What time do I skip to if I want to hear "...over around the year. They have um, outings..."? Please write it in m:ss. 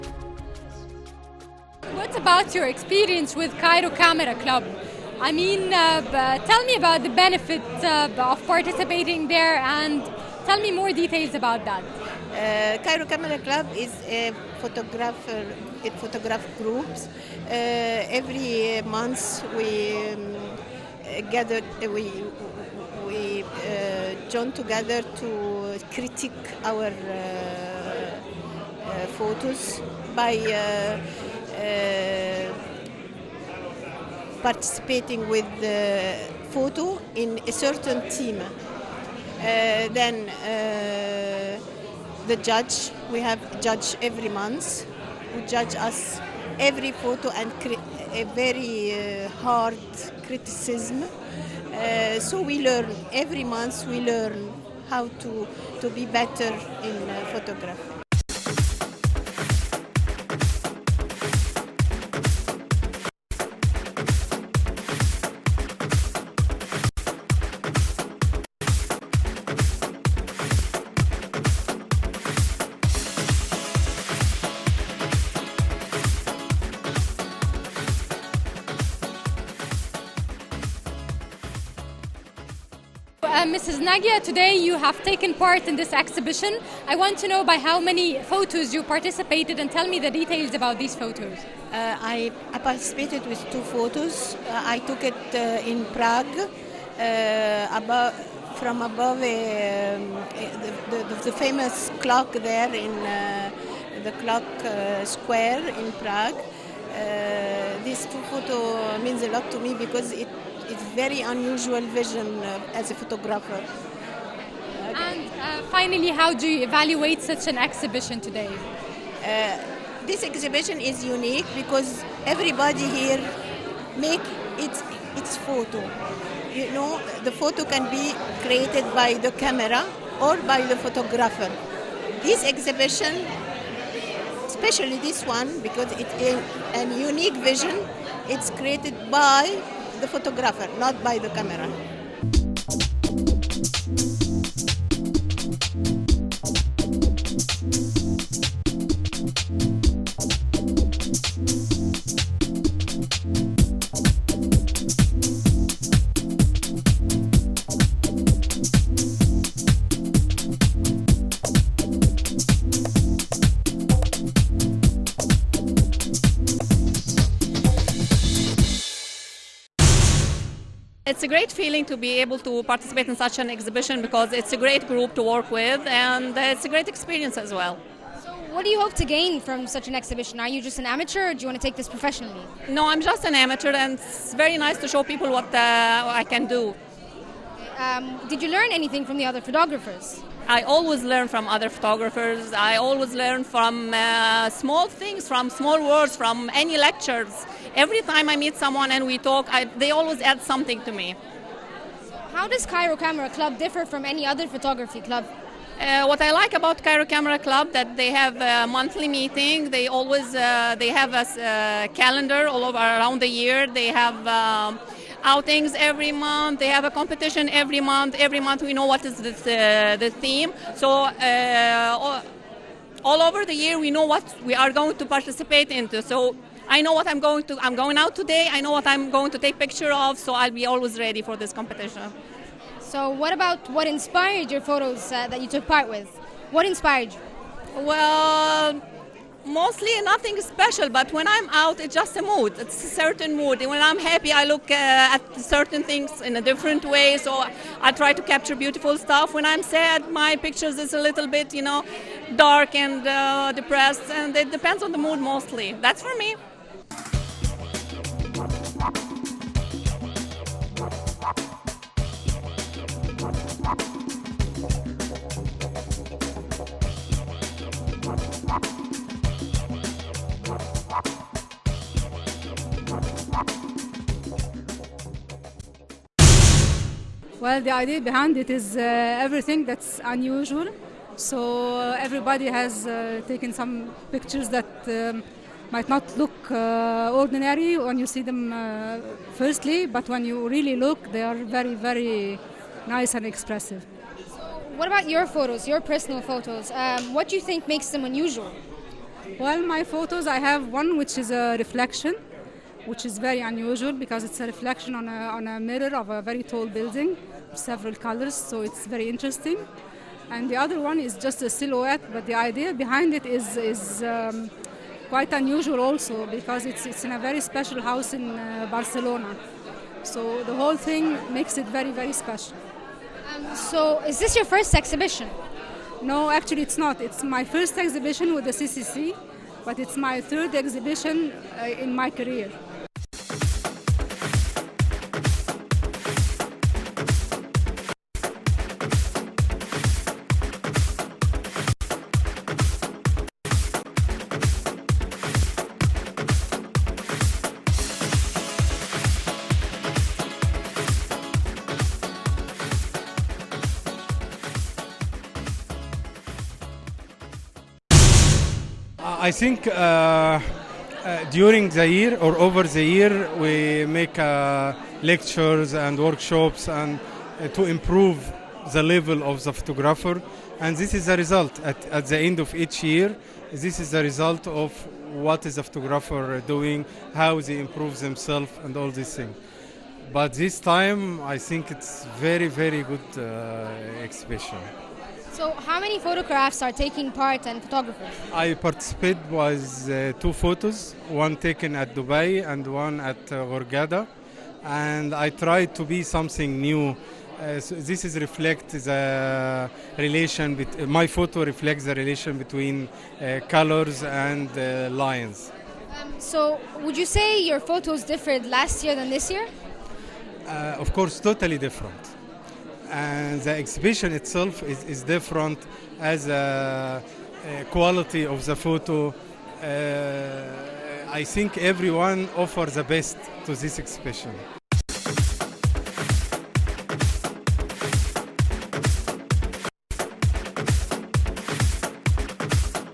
3:32.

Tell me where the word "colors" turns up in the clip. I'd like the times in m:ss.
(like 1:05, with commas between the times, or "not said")
5:07, 6:43.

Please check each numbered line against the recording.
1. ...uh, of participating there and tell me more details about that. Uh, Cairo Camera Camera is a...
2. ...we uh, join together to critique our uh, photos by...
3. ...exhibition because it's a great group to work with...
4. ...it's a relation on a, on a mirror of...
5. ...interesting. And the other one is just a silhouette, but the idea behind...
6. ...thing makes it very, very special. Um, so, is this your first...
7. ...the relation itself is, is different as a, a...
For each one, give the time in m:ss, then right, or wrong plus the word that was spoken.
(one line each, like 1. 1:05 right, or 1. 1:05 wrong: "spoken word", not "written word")
1. 0:07 wrong: "Club", not "Camera"
2. 0:23 right
3. 2:53 right
4. 5:04 wrong: "reflection", not "relation"
5. 5:09 right
6. 5:20 right
7. 6:53 wrong: "exhibition", not "relation".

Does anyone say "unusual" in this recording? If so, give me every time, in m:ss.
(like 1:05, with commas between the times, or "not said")
1:51, 4:40, 4:58, 5:03, 5:15.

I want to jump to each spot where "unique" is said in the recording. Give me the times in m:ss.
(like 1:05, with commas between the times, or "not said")
2:01, 2:17.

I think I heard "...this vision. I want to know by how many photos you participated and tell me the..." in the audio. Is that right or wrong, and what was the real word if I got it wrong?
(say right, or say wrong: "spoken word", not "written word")
wrong: "exhibition", not "vision".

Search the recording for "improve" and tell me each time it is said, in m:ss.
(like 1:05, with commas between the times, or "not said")
6:07, 6:17.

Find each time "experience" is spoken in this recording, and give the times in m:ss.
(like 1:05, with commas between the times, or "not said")
0:02, 2:56.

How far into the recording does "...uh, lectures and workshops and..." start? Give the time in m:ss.
6:04.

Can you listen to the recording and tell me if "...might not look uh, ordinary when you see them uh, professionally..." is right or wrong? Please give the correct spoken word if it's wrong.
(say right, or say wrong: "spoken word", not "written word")
wrong: "firstly", not "professionally".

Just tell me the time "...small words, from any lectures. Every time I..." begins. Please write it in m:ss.
3:15.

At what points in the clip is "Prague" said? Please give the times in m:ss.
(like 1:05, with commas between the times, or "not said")
1:35, 1:46.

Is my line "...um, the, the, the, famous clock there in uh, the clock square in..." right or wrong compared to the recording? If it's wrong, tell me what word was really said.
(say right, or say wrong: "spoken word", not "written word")
right.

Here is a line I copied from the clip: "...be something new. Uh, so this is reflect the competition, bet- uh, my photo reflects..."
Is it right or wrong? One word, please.
wrong.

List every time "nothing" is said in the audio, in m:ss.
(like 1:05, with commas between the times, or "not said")
4:00.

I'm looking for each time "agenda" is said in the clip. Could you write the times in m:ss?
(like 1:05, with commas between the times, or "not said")
not said.